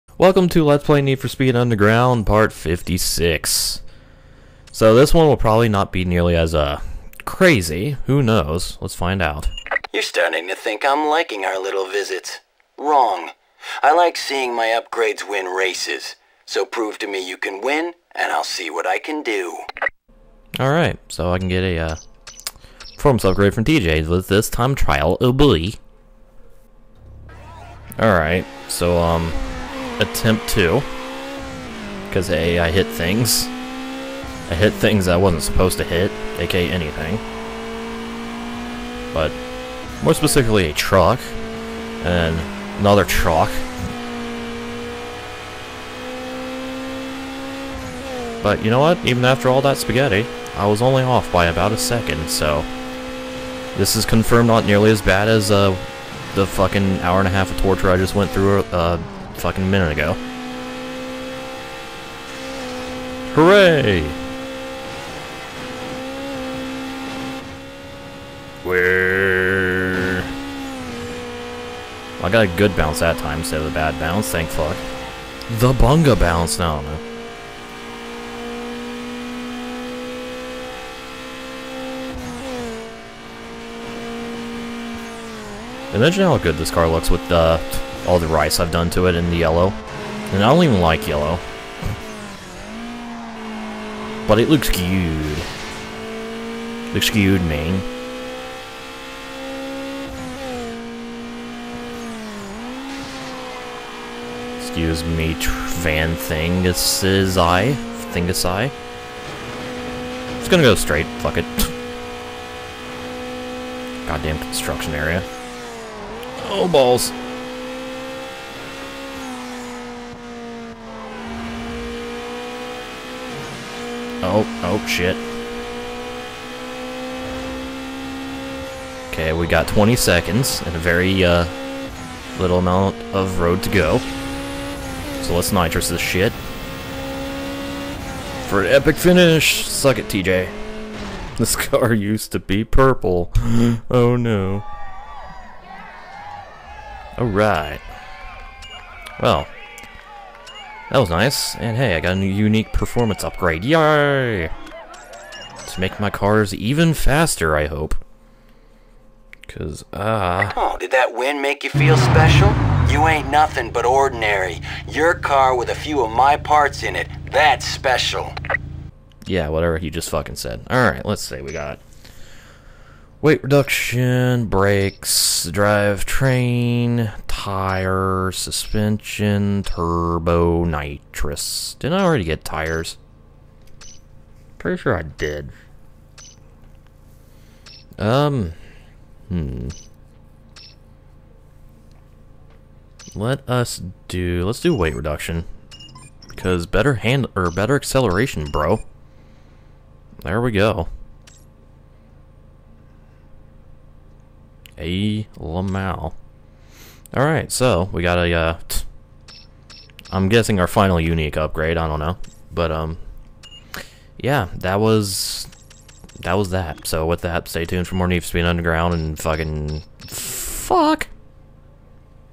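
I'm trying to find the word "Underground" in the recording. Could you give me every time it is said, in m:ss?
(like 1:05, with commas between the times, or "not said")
0:01, 3:38.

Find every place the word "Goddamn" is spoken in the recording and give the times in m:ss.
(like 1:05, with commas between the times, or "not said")
1:54.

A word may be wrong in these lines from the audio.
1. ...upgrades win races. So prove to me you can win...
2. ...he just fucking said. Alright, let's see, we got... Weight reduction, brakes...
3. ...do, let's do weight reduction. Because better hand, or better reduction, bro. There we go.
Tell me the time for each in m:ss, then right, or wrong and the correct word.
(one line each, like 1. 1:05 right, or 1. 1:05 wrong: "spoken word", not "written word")
1. 0:14 right
2. 2:49 right
3. 3:14 wrong: "acceleration", not "reduction".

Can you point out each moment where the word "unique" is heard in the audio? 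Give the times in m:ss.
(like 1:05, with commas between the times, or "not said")
2:32, 3:30.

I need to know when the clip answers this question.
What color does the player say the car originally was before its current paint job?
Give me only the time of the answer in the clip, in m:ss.
2:22.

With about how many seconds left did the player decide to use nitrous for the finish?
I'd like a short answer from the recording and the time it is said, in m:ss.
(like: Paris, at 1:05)
20, at 2:09.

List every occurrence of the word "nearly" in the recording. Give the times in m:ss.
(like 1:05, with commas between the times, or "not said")
0:06, 0:54.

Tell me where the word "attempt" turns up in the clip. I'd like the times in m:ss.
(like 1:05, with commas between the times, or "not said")
0:30.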